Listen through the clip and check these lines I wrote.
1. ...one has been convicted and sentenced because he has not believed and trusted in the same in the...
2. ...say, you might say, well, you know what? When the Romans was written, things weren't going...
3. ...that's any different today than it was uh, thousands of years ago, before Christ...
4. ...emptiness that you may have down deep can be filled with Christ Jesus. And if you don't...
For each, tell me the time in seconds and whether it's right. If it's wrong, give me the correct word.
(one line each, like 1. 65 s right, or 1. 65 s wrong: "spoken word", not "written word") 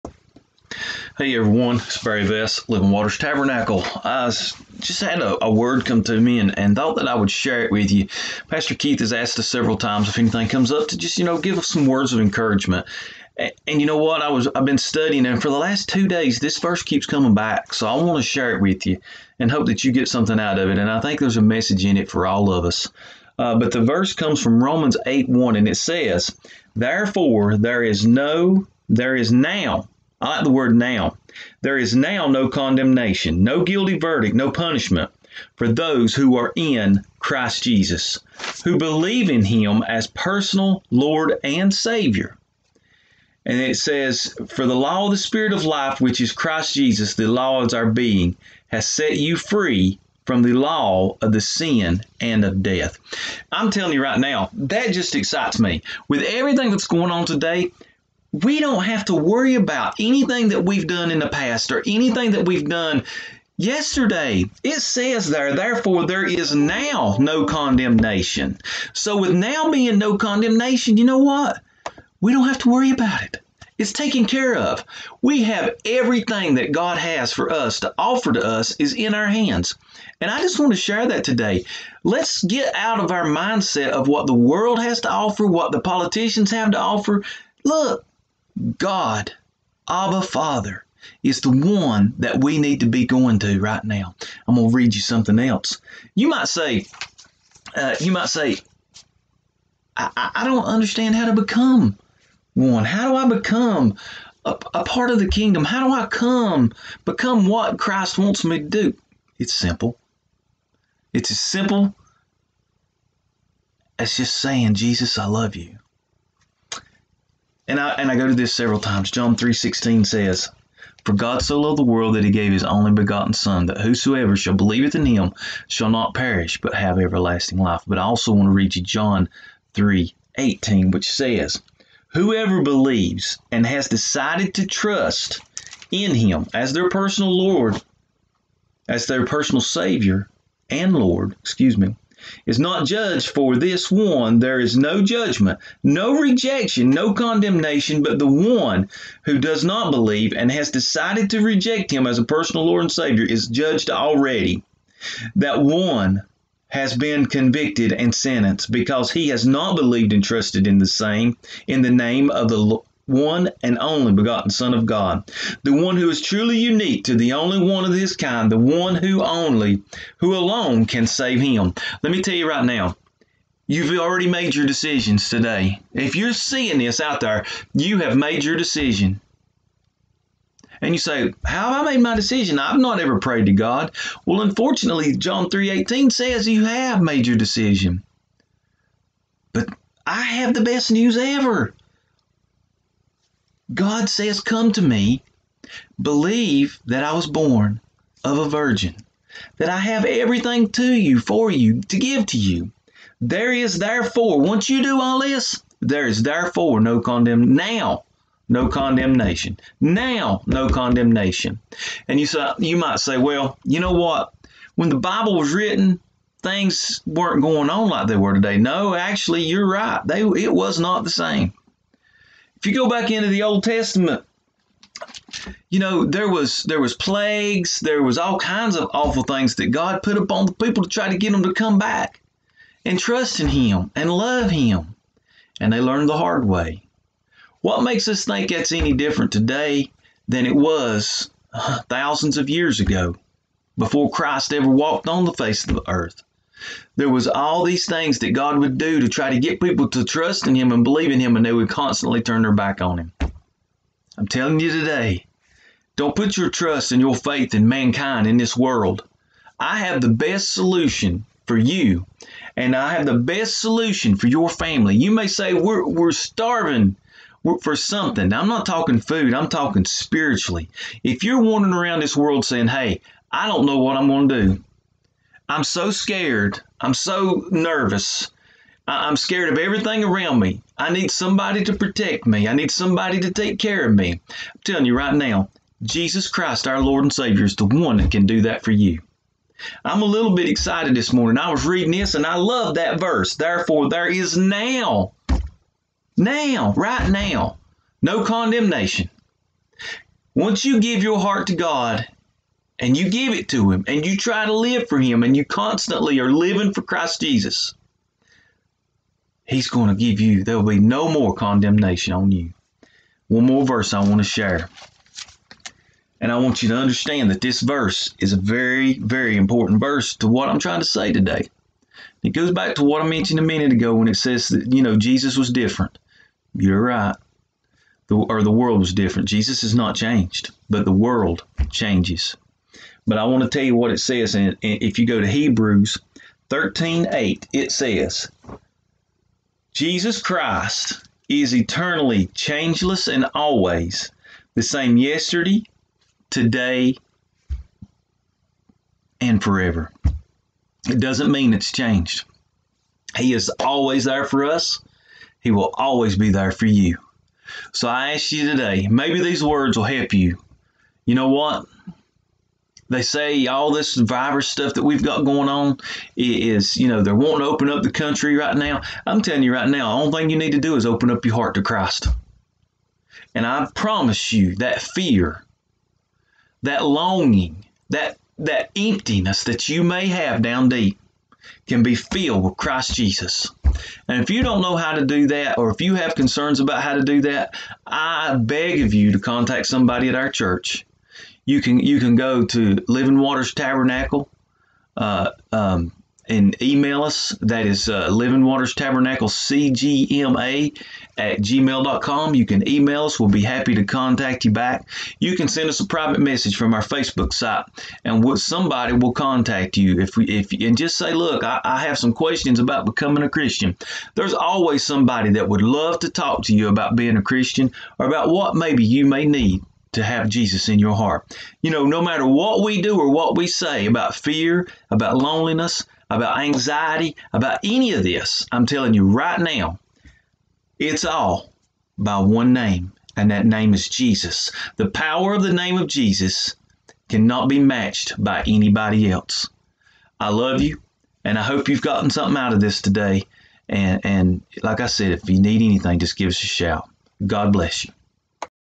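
1. 155 s right
2. 212 s wrong: "Bible", not "Romans"
3. 238 s right
4. 378 s right.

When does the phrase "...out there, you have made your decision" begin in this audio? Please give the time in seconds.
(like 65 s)
176 s.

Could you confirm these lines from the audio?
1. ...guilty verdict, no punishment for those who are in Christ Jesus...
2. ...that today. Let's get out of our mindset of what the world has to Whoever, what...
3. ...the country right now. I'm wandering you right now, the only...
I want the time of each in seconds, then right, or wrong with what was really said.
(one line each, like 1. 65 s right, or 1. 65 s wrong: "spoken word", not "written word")
1. 33 s right
2. 81 s wrong: "offer", not "Whoever"
3. 367 s wrong: "telling", not "wandering".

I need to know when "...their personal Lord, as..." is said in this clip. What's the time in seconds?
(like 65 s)
136 s.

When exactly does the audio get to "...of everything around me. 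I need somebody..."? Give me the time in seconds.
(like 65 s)
279 s.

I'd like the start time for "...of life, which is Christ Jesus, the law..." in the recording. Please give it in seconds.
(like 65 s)
45 s.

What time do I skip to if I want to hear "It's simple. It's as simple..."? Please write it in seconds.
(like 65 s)
109 s.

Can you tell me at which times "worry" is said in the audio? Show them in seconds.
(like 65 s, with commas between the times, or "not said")
59 s, 72 s.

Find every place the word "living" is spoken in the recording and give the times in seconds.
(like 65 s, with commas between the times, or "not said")
2 s, 306 s, 392 s, 398 s.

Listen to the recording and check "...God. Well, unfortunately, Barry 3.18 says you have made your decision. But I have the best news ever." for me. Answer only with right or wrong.
wrong.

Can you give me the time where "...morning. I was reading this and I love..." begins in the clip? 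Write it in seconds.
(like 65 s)
291 s.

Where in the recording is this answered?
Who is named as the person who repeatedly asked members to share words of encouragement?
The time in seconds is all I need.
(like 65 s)
8 s.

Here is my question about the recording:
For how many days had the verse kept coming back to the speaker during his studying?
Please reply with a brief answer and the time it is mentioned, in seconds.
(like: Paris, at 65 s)
2, at 15 s.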